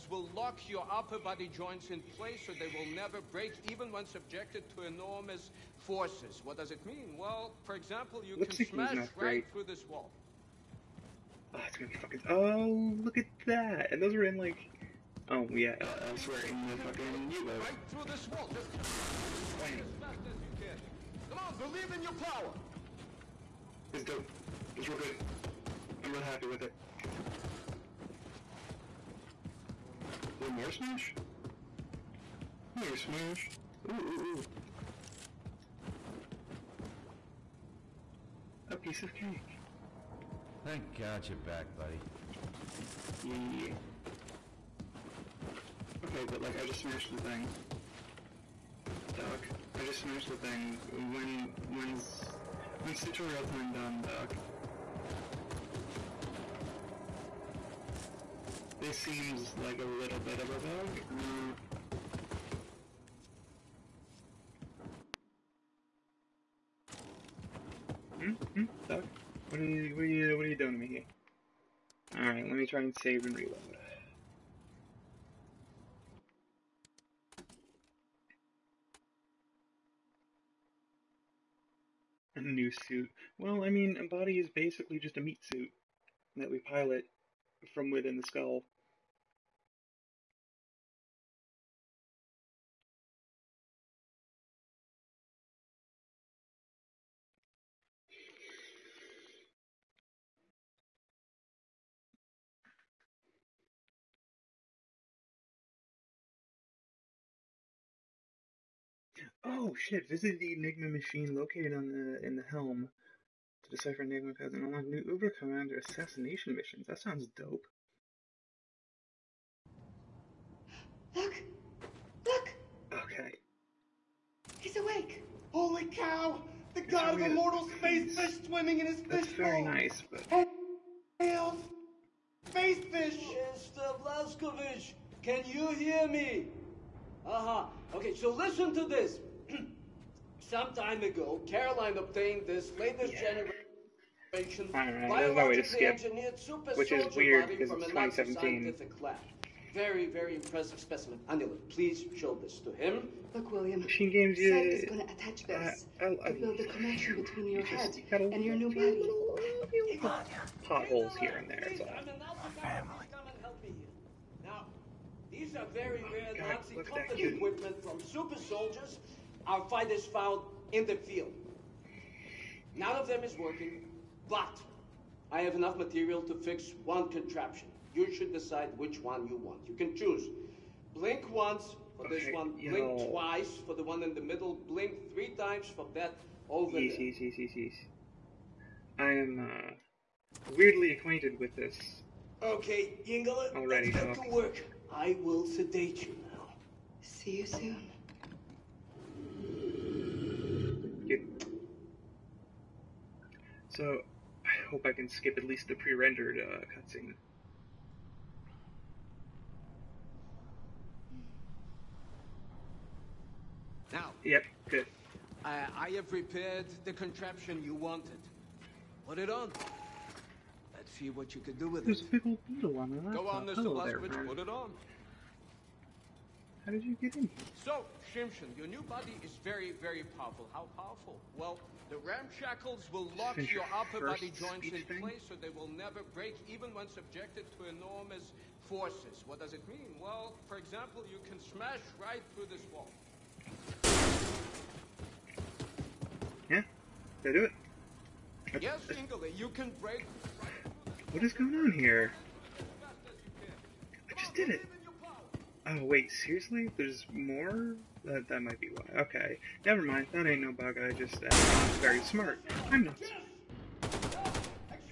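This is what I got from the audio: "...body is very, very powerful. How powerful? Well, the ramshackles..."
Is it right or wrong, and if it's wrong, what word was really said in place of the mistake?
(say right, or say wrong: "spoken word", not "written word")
right.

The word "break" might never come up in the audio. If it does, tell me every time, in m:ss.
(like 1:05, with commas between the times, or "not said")
0:03, 3:56, 4:09.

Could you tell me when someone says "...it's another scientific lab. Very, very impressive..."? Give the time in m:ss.
2:27.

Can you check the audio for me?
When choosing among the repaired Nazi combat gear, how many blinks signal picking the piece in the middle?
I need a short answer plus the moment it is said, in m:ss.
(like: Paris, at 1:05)
twice, at 3:03.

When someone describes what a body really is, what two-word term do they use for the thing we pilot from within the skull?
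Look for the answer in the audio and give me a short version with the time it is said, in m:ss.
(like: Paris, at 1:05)
meat suit, at 1:25.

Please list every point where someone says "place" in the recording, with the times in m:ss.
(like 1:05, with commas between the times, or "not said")
0:02, 3:55.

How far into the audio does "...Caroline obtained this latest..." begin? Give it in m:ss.
2:21.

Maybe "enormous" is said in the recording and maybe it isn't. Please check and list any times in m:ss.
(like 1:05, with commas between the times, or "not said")
0:04, 3:57.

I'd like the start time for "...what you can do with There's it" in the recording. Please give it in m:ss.
3:41.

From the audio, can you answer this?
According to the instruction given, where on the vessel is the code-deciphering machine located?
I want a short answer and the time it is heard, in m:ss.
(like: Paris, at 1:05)
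the helm, at 1:52.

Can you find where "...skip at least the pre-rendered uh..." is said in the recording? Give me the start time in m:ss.
3:25.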